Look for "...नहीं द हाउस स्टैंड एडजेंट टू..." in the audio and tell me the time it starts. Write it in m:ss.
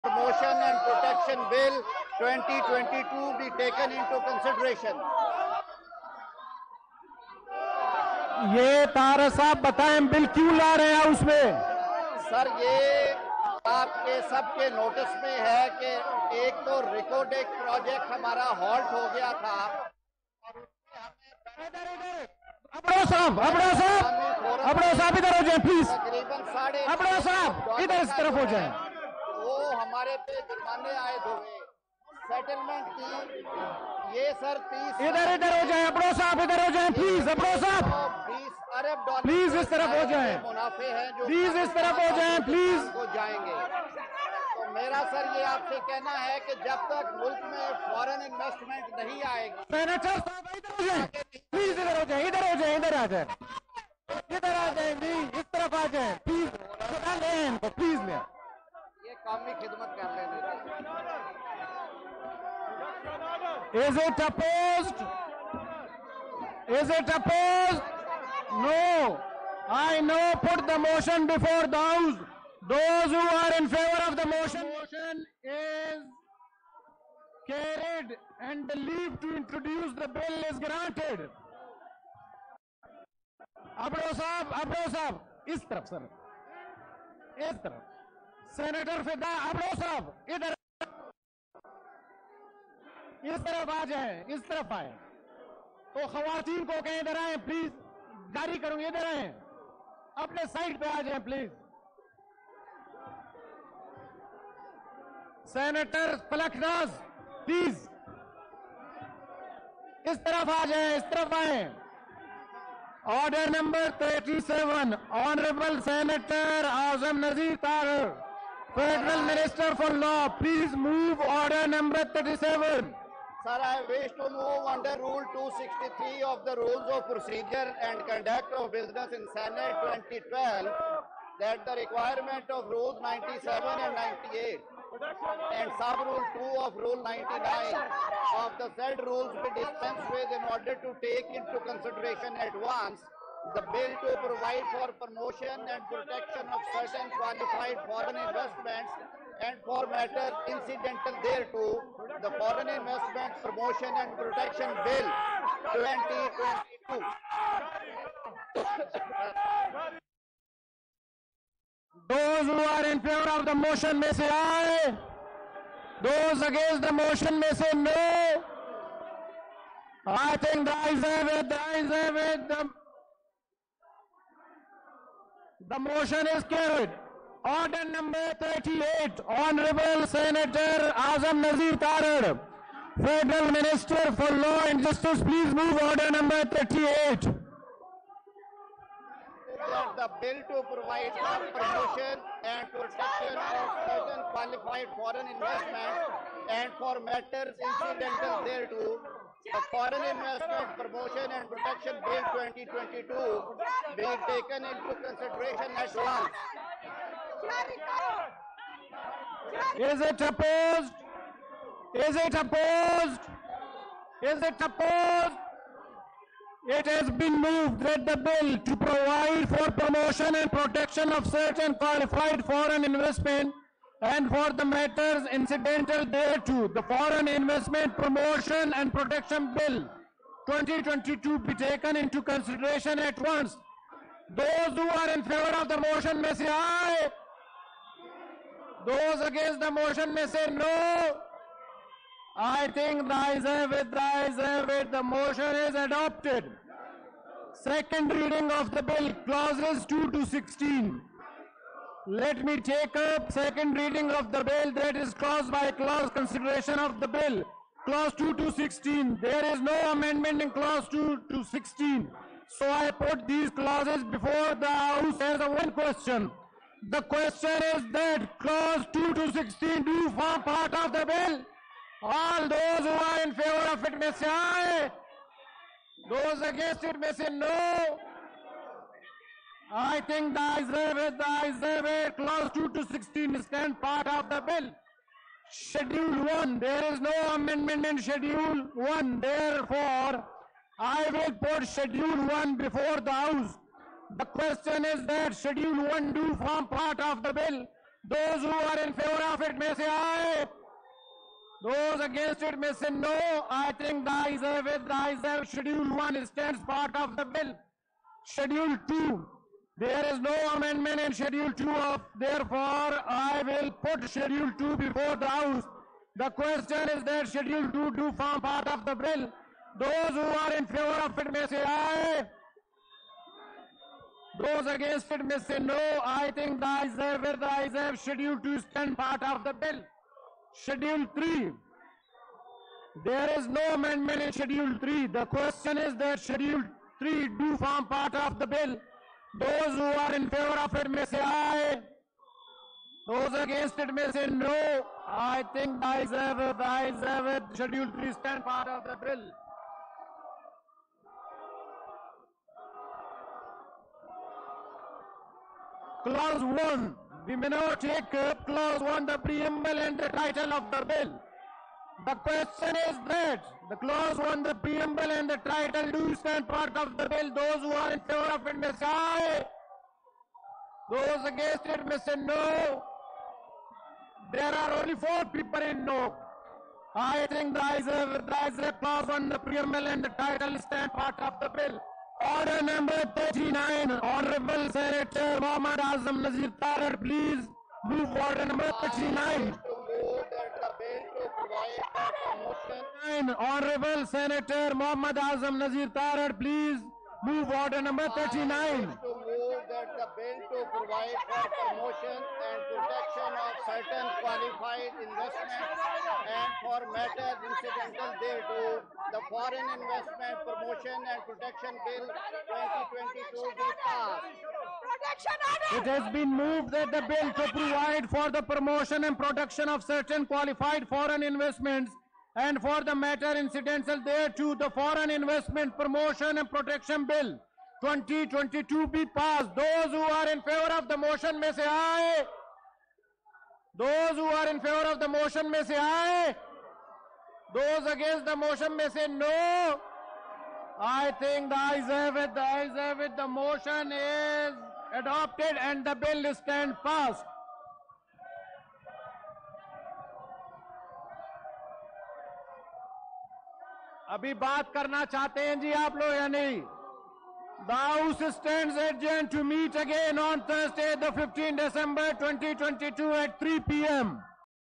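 7:36.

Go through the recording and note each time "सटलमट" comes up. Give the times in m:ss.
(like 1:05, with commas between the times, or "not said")
0:32.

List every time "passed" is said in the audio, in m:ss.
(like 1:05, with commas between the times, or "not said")
6:53, 7:09, 7:26.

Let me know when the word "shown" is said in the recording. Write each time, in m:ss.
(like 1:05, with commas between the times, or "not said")
not said.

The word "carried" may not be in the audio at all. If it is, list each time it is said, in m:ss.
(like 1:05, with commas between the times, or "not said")
1:17, 2:56.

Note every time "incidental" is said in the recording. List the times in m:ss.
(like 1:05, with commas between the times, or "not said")
2:30, 3:17, 3:45, 6:47, 7:03.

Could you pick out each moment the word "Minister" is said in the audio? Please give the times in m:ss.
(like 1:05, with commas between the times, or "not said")
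1:59, 3:03.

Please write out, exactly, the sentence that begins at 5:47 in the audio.
Schedule 3 stand part of the bill.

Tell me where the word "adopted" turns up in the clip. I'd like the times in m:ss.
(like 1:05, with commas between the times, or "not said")
4:05, 7:24.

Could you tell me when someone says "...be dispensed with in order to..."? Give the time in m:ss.
2:19.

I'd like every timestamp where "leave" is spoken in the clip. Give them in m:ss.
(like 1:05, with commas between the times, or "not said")
1:18.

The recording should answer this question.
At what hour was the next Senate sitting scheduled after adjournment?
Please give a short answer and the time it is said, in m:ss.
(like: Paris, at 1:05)
3 PM, at 7:43.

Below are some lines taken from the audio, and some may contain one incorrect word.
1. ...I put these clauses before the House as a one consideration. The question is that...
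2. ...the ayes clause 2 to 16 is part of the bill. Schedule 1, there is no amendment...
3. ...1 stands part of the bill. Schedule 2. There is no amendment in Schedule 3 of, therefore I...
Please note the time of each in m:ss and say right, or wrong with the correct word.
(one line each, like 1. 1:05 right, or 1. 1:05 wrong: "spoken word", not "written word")
1. 4:22 wrong: "question", not "consideration"
2. 4:40 right
3. 5:05 wrong: "2", not "3".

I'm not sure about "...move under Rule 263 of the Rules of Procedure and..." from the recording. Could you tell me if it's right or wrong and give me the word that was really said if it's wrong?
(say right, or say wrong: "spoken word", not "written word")
right.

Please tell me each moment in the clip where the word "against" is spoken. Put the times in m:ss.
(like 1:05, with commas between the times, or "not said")
2:46, 3:59, 4:36, 5:02, 5:24, 5:43, 6:11, 7:17.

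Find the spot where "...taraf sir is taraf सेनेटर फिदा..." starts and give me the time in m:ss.
1:25.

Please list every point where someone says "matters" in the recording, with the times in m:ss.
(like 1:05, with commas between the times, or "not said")
2:29, 3:16, 3:44, 6:46, 7:02.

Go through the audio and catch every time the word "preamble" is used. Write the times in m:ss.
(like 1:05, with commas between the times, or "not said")
5:59, 6:04, 6:19.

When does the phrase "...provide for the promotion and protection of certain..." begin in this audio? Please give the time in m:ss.
6:57.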